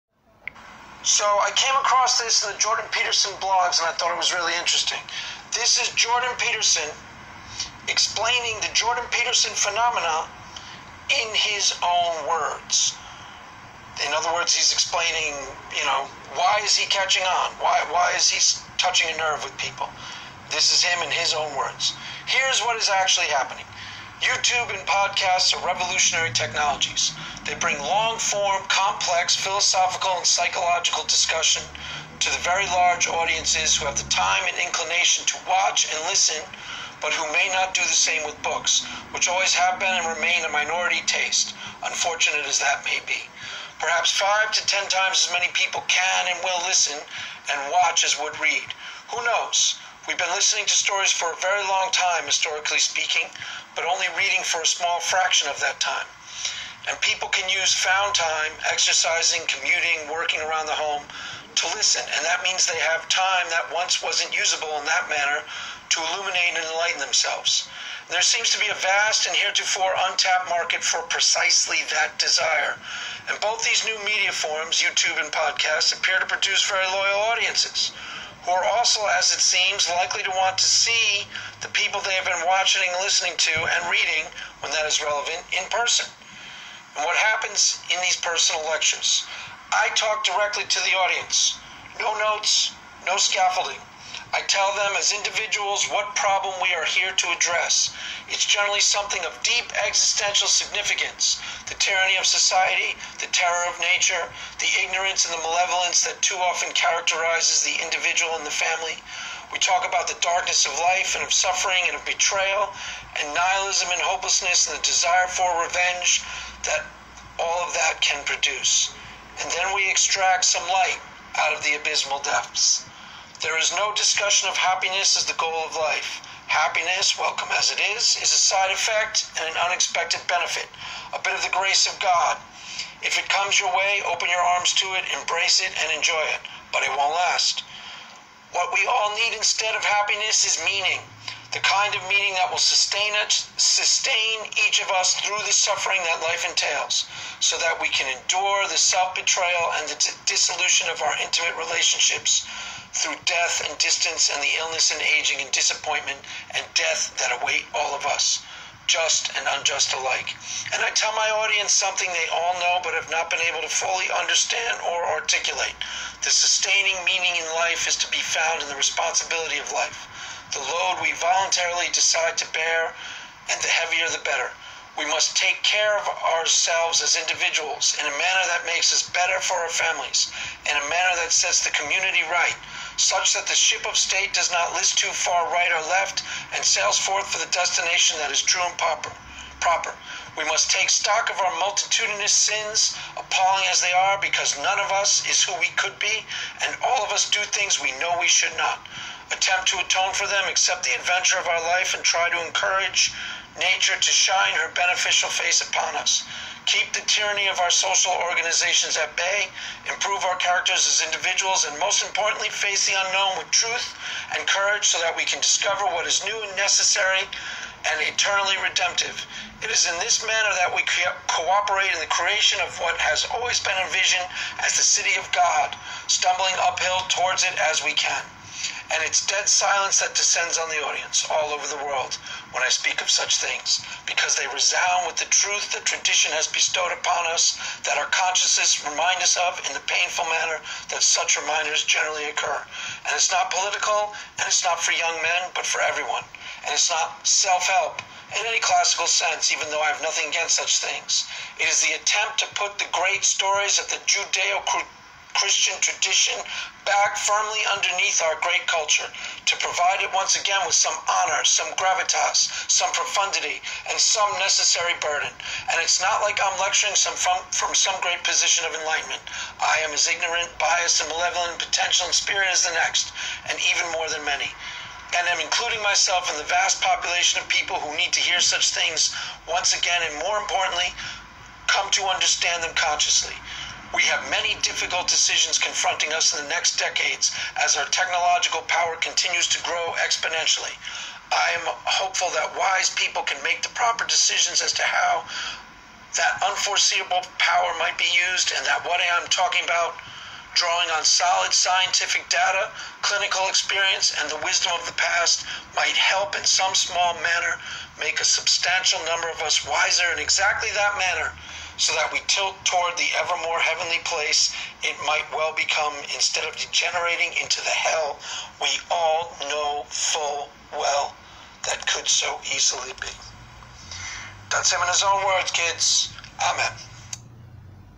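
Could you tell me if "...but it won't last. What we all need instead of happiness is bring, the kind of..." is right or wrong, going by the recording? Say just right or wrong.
wrong.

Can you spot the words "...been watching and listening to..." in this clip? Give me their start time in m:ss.
1:22.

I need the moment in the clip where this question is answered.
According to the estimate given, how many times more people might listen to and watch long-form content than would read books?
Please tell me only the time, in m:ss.
0:44.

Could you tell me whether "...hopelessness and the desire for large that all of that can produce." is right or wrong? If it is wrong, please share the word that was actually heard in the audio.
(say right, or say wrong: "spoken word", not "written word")
wrong: "revenge", not "large".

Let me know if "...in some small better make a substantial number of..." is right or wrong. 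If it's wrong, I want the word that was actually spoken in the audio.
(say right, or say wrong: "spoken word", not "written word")
wrong: "manner", not "better".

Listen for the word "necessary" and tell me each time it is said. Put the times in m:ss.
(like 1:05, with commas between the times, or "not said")
3:36, 4:24.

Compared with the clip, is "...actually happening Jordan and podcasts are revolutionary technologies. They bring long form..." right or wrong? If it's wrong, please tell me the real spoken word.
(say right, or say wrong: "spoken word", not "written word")
wrong: "YouTube", not "Jordan".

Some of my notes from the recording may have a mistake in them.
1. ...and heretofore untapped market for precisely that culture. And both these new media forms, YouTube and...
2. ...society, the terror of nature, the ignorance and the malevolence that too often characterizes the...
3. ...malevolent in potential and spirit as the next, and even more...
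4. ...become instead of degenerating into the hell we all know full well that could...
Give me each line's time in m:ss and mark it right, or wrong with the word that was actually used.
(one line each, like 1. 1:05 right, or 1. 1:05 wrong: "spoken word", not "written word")
1. 1:09 wrong: "desire", not "culture"
2. 1:42 right
3. 4:31 right
4. 5:15 right.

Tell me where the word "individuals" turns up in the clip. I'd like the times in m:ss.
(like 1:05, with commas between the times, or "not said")
1:35, 1:47, 2:57, 3:31.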